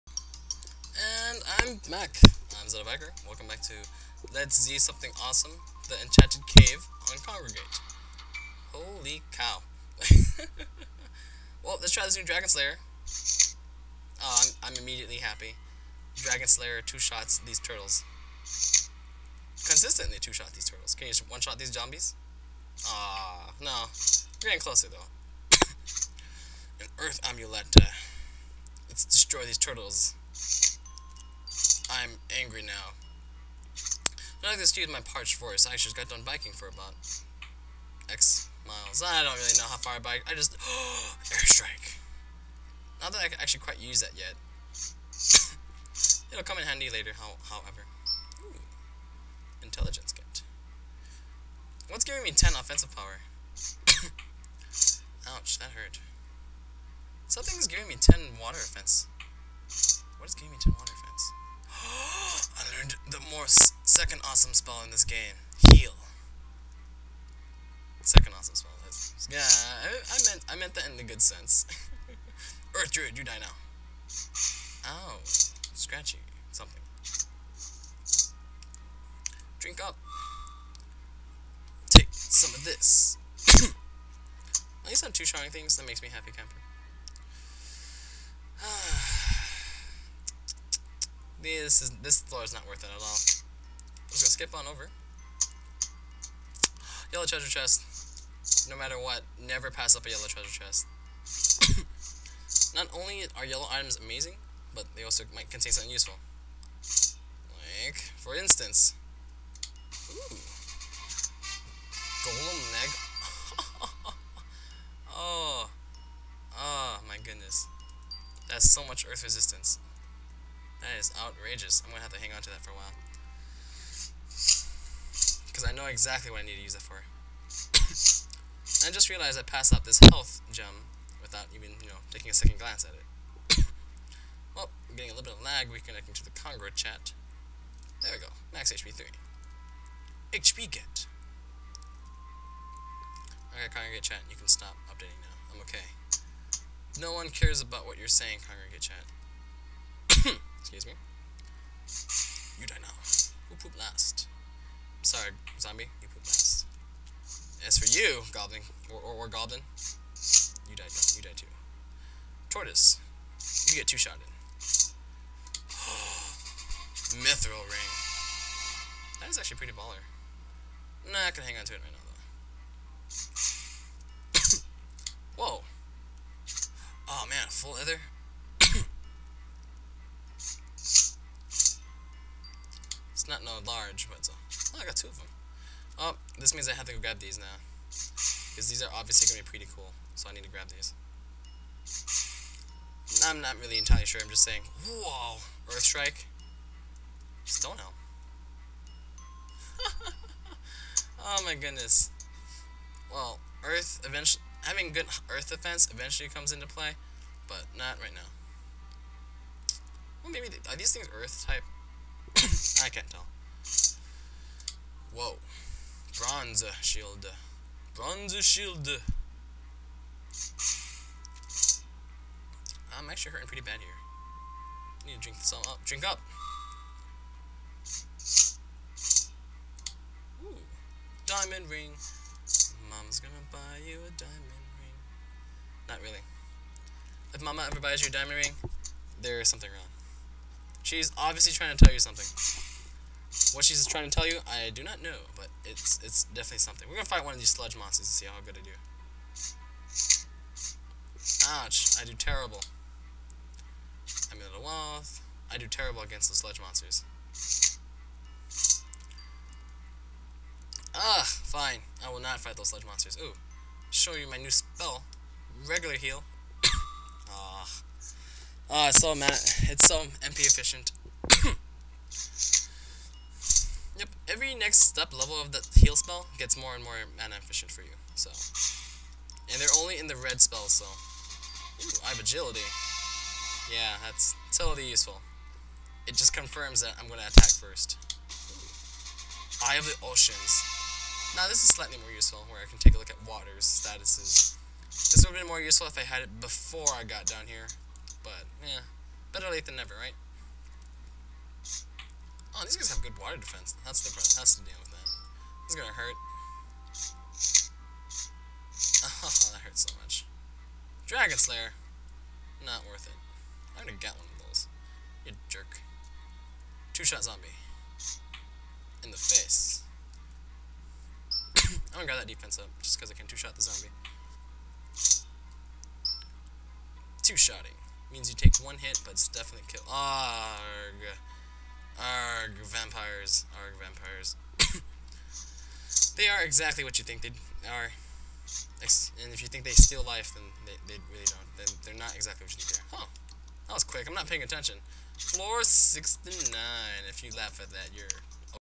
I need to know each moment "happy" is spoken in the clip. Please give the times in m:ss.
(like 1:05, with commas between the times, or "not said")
0:15, 1:26.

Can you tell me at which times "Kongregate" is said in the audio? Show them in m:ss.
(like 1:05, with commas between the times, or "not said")
0:07, 2:16, 2:23, 2:28.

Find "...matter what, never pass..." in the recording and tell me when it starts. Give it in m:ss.
1:38.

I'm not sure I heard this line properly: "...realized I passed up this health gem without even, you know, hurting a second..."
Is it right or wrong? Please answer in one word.
wrong.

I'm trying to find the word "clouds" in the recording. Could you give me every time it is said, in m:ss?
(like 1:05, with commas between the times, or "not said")
not said.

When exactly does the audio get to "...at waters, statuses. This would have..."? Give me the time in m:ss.
4:53.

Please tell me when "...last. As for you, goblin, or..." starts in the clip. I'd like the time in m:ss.
2:36.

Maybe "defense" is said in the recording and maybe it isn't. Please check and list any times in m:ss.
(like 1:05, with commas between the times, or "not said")
3:25, 5:03, 5:22.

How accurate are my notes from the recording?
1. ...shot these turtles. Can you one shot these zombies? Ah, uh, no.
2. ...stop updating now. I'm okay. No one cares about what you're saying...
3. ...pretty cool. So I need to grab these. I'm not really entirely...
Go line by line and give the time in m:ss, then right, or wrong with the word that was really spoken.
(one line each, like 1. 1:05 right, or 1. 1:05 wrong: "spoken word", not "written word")
1. 0:20 right
2. 2:24 right
3. 3:09 right.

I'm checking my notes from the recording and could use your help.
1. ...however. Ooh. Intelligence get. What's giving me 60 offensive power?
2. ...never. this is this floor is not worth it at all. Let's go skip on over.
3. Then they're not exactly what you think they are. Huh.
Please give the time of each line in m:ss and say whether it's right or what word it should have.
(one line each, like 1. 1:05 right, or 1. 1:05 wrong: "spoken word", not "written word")
1. 0:47 wrong: "10", not "60"
2. 1:26 wrong: "camper", not "never"
3. 5:41 right.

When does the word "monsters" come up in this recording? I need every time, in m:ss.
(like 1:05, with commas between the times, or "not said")
4:07, 4:16, 4:22.